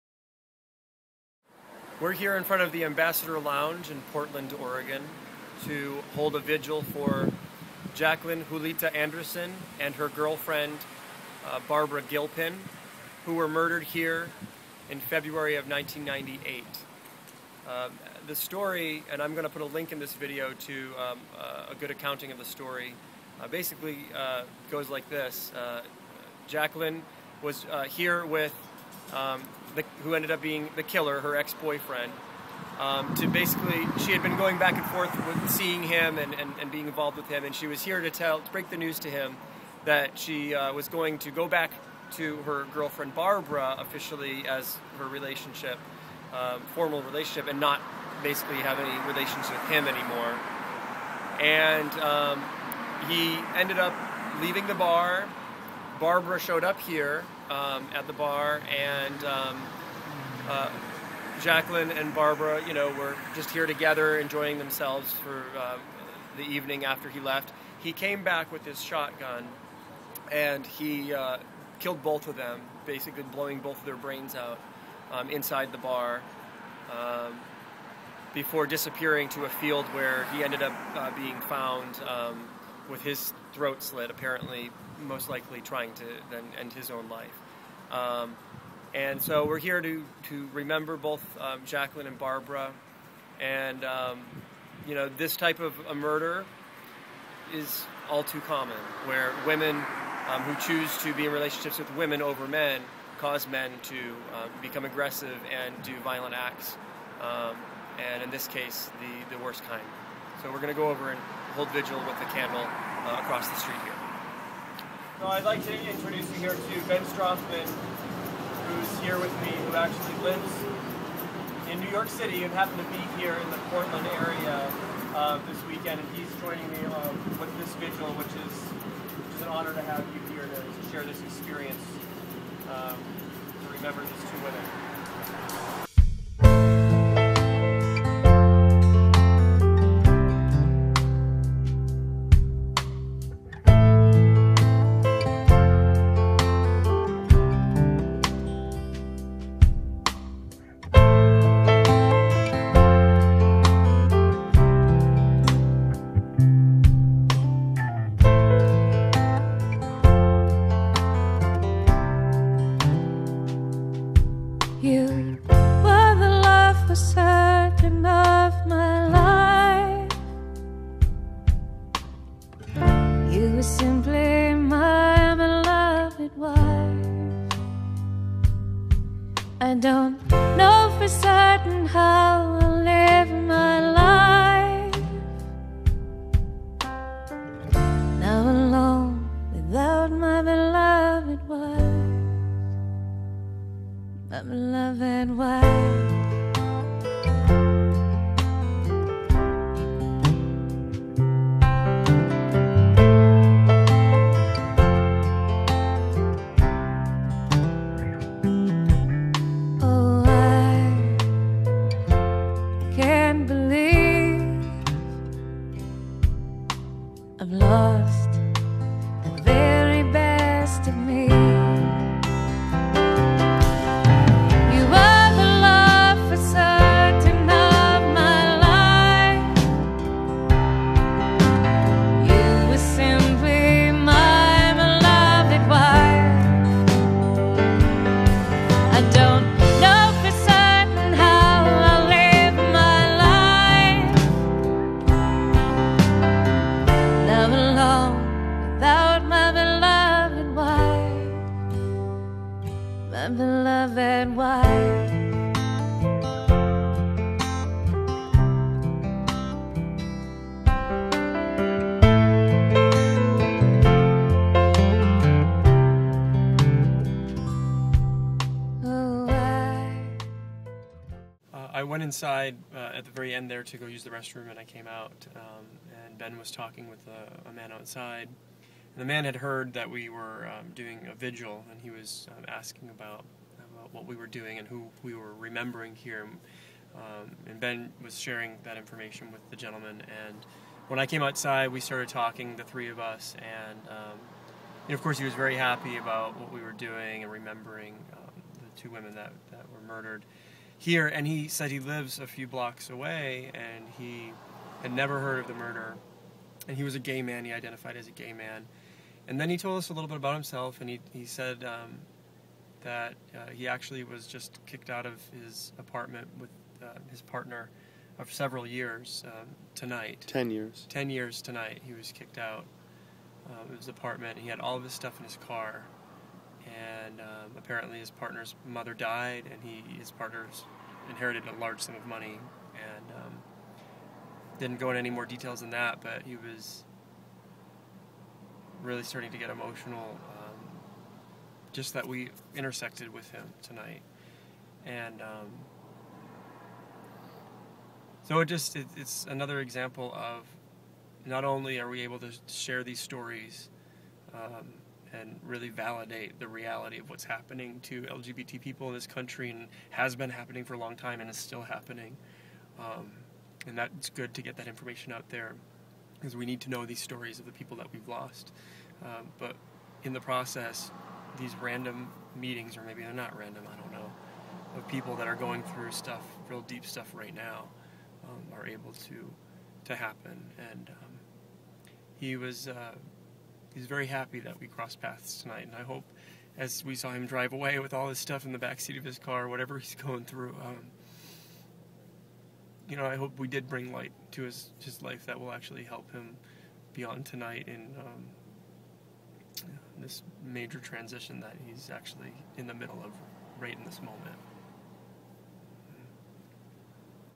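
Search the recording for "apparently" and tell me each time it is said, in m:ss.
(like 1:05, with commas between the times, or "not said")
1:24, 5:27.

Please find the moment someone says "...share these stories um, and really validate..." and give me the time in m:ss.
5:52.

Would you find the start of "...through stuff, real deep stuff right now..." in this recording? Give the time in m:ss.
6:15.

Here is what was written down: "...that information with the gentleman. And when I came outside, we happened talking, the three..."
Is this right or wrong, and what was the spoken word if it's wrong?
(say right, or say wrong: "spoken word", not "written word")
wrong: "started", not "happened".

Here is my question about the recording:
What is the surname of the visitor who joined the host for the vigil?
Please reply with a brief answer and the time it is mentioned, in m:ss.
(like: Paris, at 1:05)
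Strothmann, at 1:57.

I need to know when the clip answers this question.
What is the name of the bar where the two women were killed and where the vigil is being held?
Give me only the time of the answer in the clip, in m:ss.
0:02.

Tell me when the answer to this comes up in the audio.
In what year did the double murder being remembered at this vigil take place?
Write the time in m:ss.
0:15.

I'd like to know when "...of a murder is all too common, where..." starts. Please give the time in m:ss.
1:35.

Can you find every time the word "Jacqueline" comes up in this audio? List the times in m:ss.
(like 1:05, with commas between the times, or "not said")
0:07, 0:26, 1:01, 1:31.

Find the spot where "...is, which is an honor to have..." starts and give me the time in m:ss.
2:08.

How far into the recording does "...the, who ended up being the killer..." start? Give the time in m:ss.
0:29.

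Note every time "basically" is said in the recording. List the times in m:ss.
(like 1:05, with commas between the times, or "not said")
0:23, 0:33, 0:48, 1:12.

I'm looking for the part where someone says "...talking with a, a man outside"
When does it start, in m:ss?
4:36.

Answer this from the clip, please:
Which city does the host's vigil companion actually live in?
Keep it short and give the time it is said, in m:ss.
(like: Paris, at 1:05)
New York City, at 2:01.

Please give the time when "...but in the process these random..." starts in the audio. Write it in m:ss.
6:09.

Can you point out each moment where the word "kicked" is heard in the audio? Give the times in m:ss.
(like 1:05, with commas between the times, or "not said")
5:14, 5:22.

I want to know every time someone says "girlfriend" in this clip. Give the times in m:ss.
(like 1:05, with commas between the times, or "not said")
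0:10, 0:42.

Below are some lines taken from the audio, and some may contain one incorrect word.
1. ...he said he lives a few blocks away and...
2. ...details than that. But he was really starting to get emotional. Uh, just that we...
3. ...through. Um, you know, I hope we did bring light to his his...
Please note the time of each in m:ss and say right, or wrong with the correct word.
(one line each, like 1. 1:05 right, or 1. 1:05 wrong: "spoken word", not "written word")
1. 5:01 right
2. 5:35 right
3. 6:30 right.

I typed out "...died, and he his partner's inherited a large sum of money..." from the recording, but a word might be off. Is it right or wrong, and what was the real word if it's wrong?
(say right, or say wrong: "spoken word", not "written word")
right.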